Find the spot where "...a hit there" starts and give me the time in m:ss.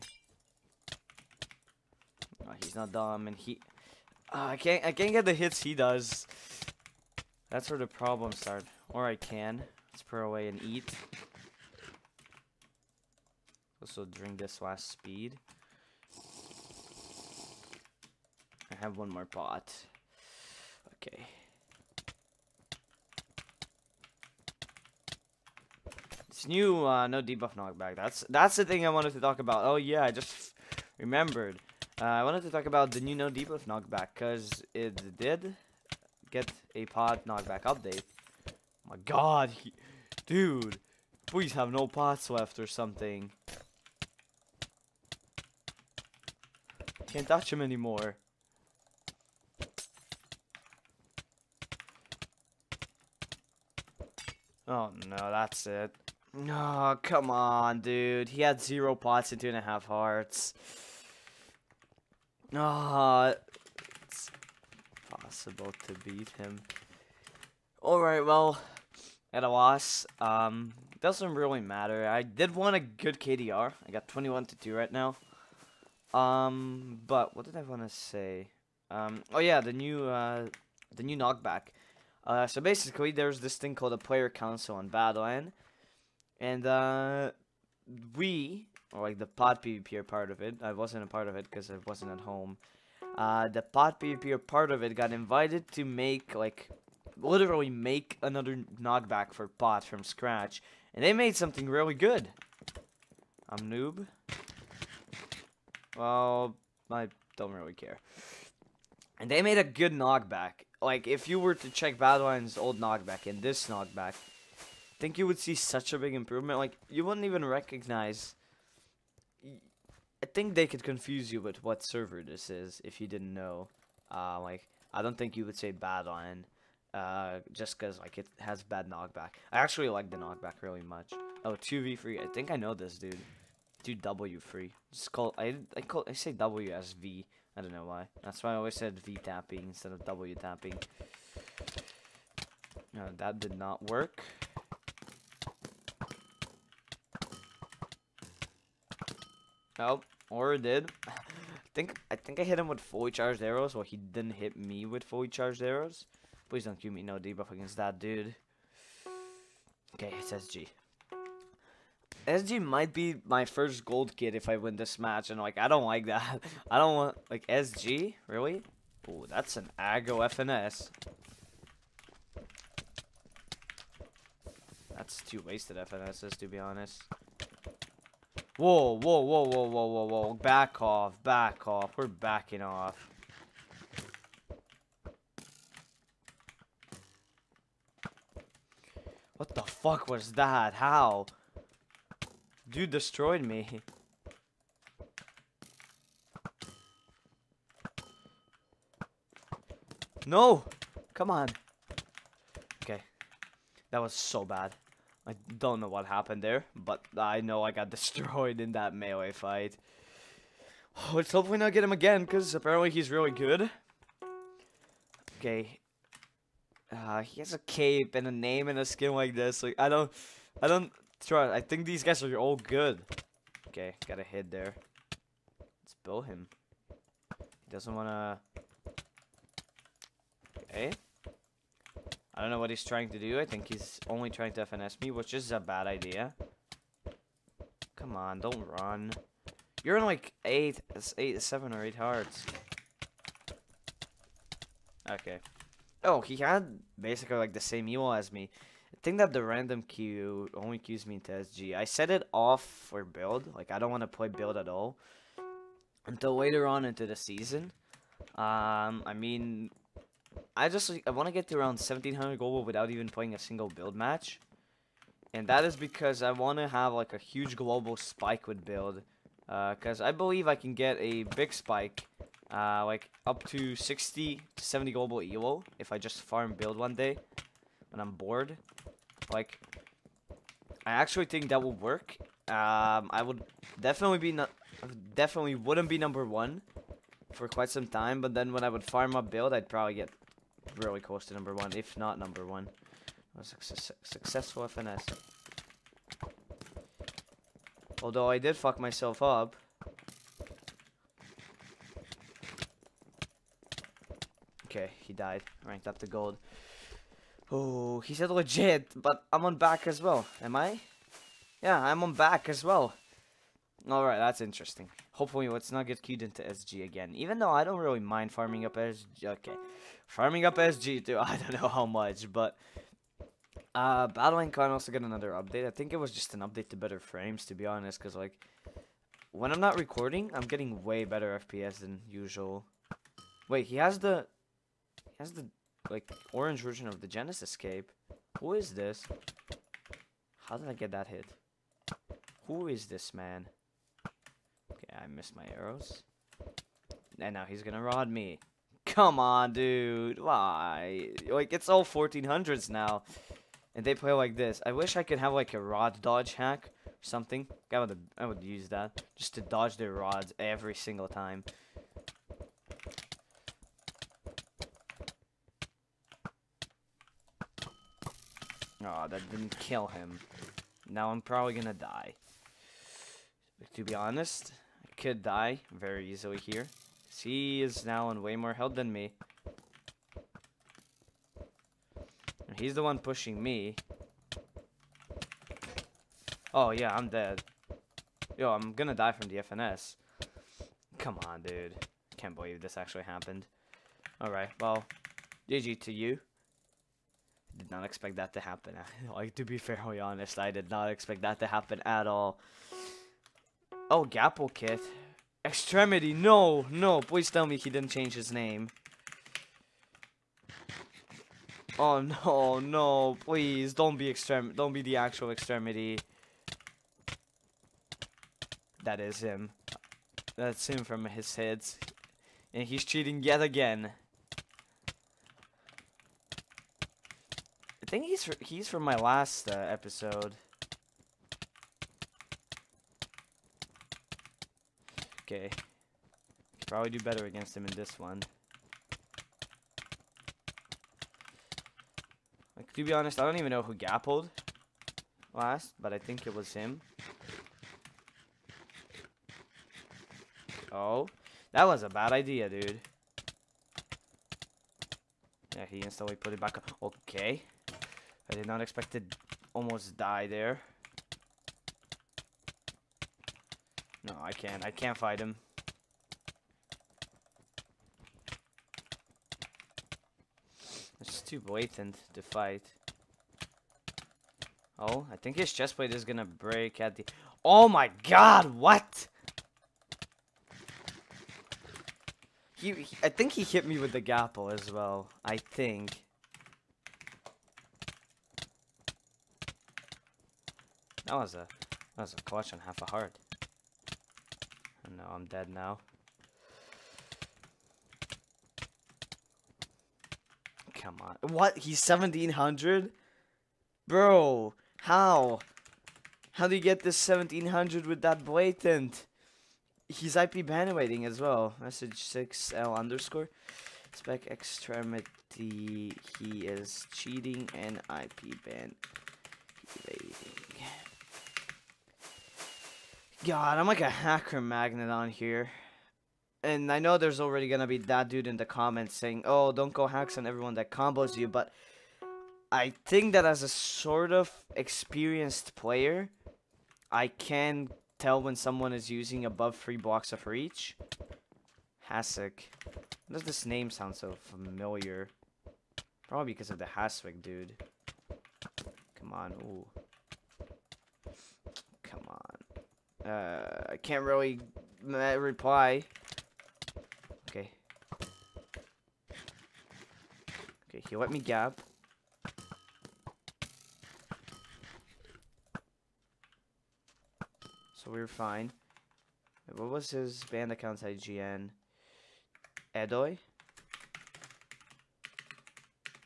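3:44.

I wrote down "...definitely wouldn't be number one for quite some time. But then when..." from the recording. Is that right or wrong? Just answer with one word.
right.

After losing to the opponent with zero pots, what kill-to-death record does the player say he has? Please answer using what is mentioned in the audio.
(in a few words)
21 to 2.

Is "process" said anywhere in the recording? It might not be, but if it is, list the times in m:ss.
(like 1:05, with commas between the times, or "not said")
not said.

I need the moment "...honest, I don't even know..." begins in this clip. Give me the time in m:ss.
7:22.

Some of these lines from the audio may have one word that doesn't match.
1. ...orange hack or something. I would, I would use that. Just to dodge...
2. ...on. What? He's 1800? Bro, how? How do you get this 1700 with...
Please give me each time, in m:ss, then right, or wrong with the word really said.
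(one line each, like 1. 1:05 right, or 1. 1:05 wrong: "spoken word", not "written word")
1. 5:56 wrong: "dodge", not "orange"
2. 8:21 wrong: "1700", not "1800".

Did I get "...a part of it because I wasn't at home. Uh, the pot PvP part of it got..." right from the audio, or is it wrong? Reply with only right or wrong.
right.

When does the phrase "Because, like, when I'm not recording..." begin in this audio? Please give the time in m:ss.
5:27.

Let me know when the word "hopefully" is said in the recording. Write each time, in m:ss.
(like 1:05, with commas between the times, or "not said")
3:31, 5:15.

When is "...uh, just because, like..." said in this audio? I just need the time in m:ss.
2:06.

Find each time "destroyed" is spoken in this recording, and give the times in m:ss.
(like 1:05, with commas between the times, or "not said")
3:12, 3:27.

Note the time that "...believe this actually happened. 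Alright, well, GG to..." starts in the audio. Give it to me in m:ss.
6:32.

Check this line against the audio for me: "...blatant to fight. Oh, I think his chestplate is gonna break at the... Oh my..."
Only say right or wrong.
right.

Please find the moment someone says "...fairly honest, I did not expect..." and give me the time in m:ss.
6:39.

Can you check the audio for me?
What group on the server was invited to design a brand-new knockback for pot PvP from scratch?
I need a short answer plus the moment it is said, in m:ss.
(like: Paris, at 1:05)
player council, at 1:23.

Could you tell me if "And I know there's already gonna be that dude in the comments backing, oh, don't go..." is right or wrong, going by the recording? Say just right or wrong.
wrong.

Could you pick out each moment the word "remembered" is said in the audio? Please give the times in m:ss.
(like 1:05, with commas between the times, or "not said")
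0:30.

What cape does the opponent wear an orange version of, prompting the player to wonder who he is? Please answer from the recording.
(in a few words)
Genesis cape.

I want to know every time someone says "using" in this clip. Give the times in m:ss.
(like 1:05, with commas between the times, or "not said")
8:58.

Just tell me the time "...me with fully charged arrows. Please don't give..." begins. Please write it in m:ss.
2:34.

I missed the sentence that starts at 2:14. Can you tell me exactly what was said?
Just call, I, I, call, I say W as V.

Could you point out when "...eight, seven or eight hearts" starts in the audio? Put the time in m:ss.
4:01.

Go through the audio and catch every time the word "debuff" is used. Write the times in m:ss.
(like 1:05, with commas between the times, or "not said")
0:27, 0:33, 2:37.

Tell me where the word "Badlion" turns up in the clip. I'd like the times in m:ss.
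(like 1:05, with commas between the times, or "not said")
1:24, 1:51, 2:05.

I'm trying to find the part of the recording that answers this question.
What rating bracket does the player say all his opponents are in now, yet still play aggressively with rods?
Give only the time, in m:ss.
5:51.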